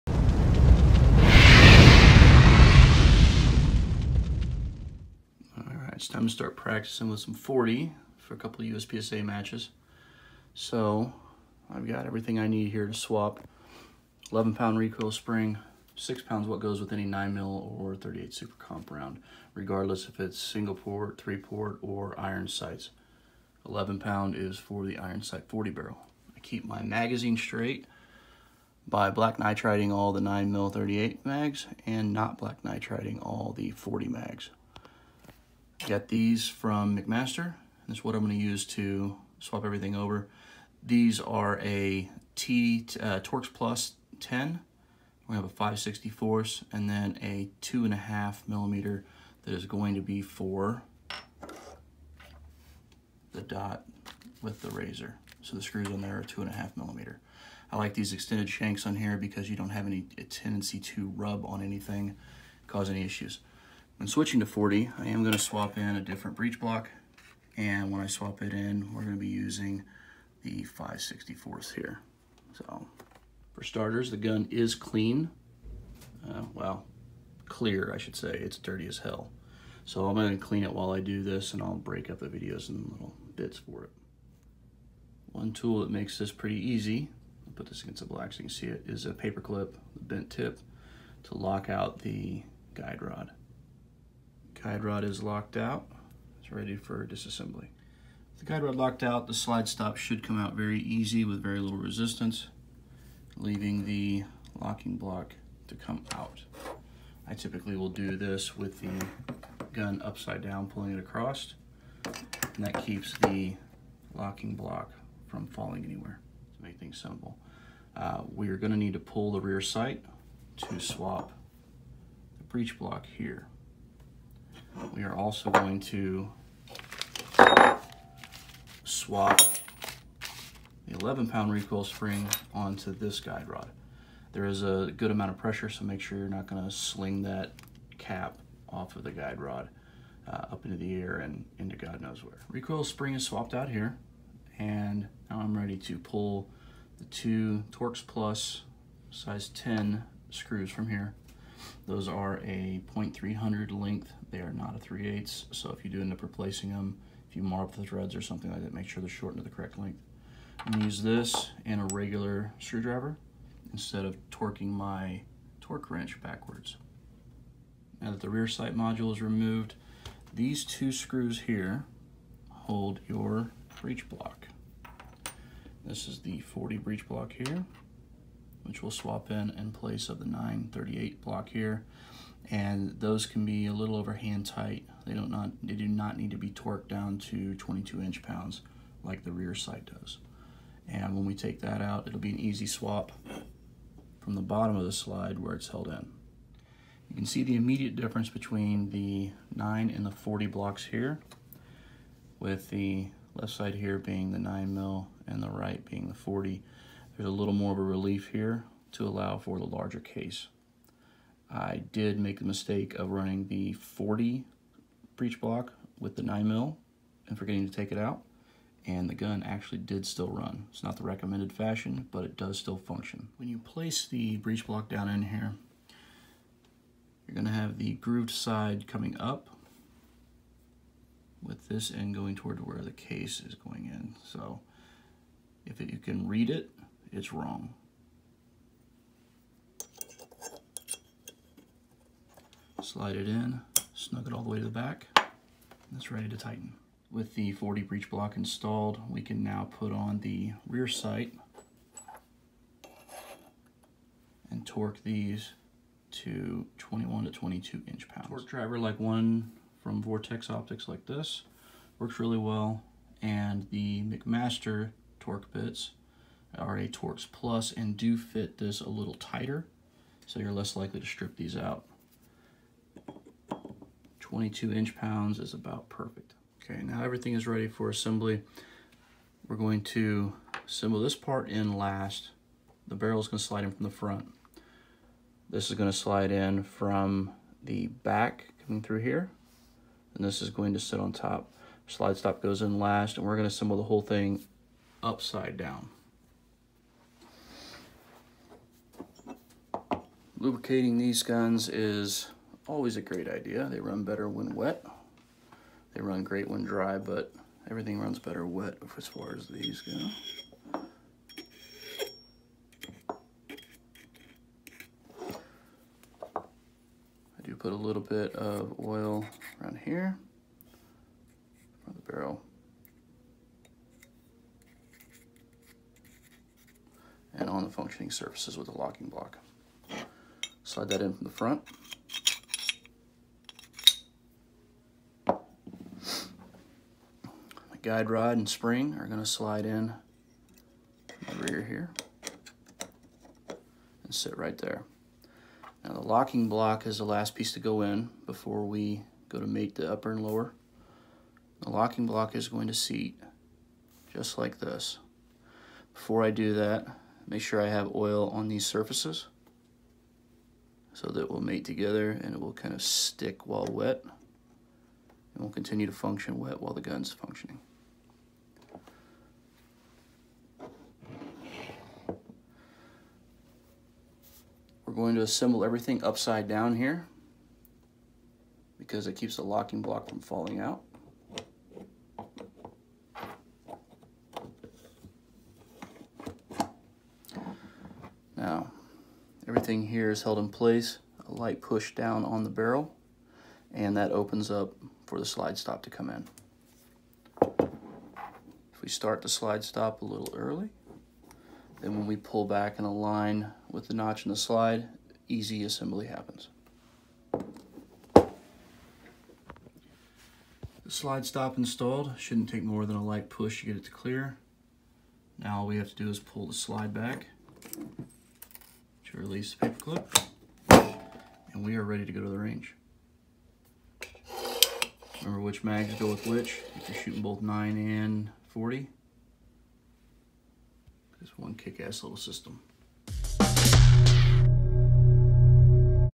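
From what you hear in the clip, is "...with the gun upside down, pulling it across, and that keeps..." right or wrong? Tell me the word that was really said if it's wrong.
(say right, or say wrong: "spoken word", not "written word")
right.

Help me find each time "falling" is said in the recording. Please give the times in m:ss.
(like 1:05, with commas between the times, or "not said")
1:55, 6:20.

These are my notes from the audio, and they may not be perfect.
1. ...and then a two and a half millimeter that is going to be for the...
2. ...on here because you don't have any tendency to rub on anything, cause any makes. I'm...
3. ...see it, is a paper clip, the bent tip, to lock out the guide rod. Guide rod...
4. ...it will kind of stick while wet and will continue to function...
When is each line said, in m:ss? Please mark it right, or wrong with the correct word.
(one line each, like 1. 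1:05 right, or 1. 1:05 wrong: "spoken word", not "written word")
1. 0:46 right
2. 0:58 wrong: "issues", not "makes"
3. 1:28 right
4. 6:02 right.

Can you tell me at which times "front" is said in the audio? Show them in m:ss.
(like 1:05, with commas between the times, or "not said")
4:43, 5:31.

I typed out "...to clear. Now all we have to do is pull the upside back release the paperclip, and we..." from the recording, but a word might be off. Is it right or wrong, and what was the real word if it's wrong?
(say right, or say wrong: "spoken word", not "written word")
wrong: "slide", not "upside".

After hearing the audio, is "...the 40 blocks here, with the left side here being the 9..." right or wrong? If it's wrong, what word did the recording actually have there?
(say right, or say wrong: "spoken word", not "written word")
right.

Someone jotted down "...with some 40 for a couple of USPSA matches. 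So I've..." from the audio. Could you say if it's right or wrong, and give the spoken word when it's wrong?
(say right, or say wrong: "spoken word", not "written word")
right.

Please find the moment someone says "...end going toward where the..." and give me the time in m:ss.
3:51.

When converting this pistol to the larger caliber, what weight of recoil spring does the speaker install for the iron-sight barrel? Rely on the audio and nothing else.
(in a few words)
11 pound.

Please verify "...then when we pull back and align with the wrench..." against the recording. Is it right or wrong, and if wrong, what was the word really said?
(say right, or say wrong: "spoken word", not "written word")
wrong: "notch", not "wrench".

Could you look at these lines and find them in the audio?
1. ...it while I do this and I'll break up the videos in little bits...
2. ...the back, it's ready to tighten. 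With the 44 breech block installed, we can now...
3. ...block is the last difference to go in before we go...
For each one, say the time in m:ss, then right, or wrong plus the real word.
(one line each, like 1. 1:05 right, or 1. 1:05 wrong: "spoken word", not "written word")
1. 1:20 right
2. 4:04 wrong: "40", not "44"
3. 5:46 wrong: "piece", not "difference".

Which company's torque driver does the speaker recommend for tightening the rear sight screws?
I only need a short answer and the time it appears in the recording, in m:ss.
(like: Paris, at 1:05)
Vortex Optics, at 4:20.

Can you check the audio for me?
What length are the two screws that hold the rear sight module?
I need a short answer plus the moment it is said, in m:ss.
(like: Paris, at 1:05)
0.300, at 2:32.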